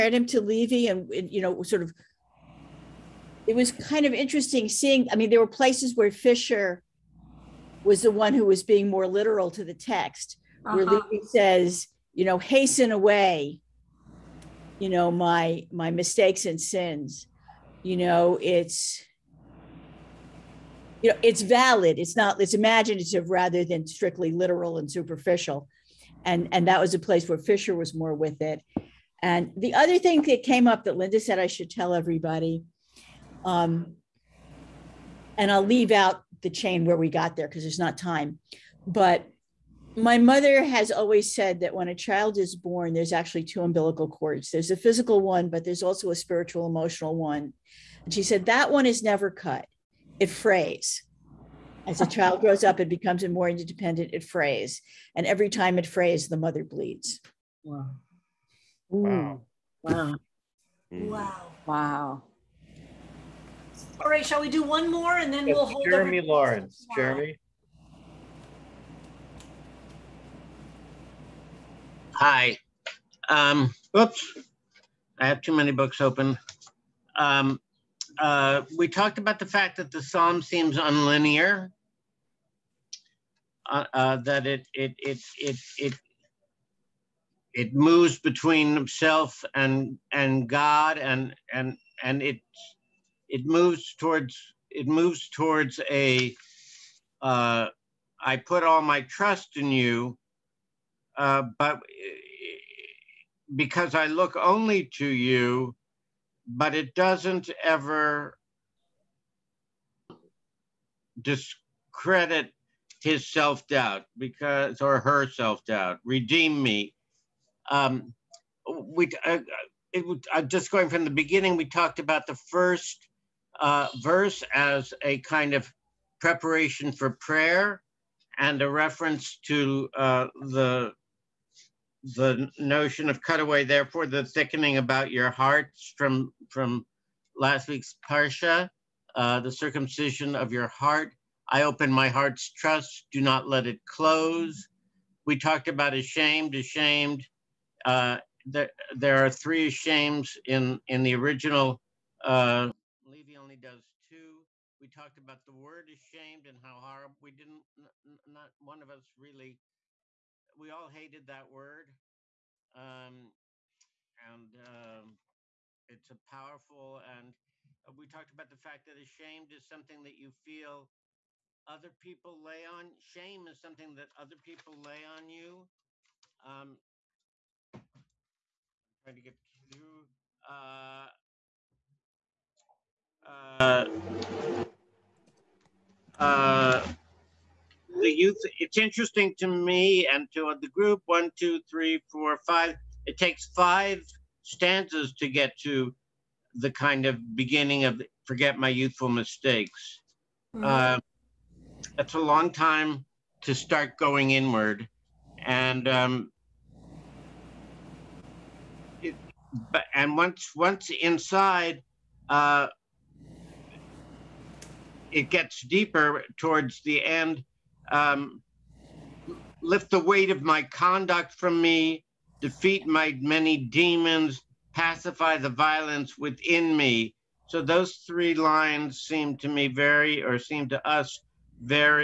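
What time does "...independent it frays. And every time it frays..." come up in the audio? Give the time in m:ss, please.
0:53.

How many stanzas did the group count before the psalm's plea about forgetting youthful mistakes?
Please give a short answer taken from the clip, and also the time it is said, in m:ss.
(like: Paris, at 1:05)
5, at 3:13.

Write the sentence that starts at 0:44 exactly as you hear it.
There's a physical one, but there's also a spiritual, emotional one.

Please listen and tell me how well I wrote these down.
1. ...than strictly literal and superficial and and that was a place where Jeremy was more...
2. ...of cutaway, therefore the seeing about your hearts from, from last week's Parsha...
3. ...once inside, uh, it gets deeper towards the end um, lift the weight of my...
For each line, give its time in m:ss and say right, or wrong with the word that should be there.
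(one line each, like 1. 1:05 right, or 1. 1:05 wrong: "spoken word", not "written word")
1. 0:23 wrong: "Fischer", not "Jeremy"
2. 2:13 wrong: "thickening", not "seeing"
3. 3:30 right.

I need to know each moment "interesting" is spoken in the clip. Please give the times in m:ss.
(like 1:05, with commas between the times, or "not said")
0:04, 3:08.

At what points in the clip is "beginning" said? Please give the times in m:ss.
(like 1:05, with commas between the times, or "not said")
2:01, 3:17.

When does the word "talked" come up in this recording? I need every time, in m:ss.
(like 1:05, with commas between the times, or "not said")
1:18, 2:01, 2:25, 2:34, 2:48.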